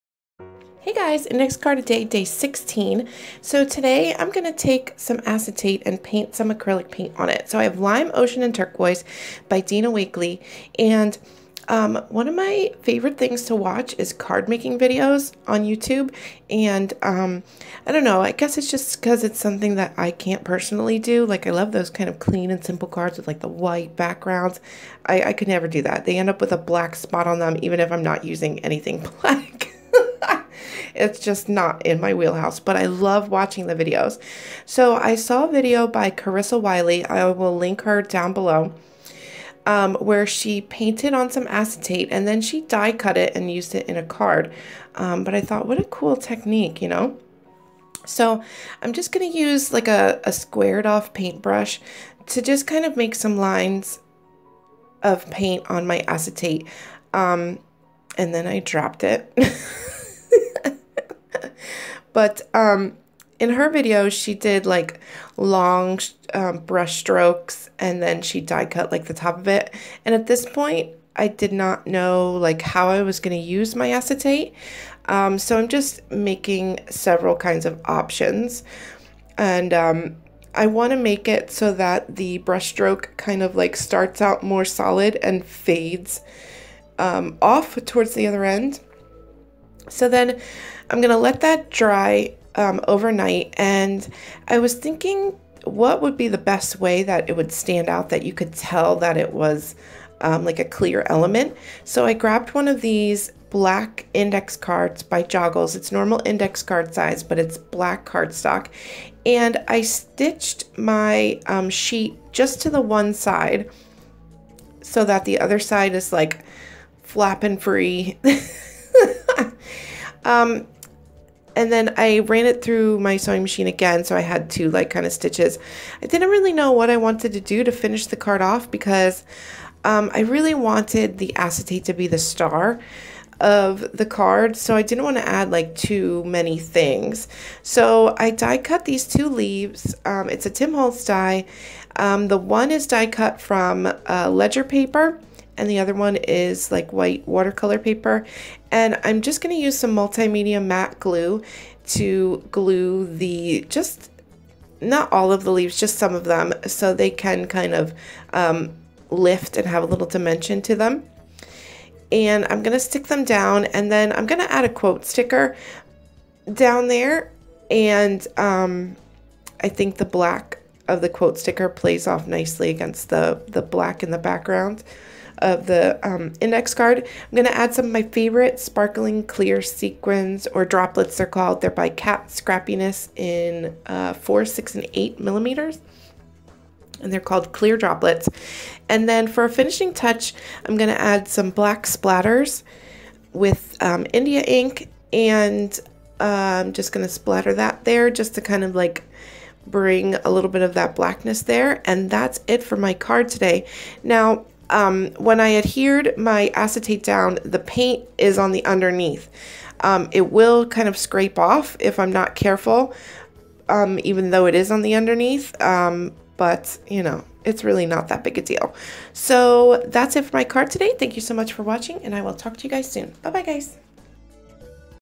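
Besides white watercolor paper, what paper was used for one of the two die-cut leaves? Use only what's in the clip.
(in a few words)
Ledger paper.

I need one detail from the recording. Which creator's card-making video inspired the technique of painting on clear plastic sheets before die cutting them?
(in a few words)
Carissa Wiley.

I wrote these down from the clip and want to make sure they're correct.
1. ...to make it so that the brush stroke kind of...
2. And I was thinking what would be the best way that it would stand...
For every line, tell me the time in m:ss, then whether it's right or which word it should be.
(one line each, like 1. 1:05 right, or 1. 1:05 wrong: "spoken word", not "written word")
1. 1:20 right
2. 1:33 right.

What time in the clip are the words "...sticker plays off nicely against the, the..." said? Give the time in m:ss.
2:51.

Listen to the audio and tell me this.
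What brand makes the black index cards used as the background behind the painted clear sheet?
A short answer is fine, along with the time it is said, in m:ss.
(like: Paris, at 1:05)
Joggles, at 1:45.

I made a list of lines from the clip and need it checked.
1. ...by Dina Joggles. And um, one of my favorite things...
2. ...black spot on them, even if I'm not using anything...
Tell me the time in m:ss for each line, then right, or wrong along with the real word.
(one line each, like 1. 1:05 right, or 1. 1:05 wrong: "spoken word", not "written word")
1. 0:09 wrong: "Wakley", not "Joggles"
2. 0:26 right.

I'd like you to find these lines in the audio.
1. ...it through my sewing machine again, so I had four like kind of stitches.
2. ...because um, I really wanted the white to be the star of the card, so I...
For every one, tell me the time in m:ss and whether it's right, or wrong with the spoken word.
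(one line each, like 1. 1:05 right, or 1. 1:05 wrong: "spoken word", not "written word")
1. 2:02 wrong: "two", not "four"
2. 2:08 wrong: "acetate", not "white".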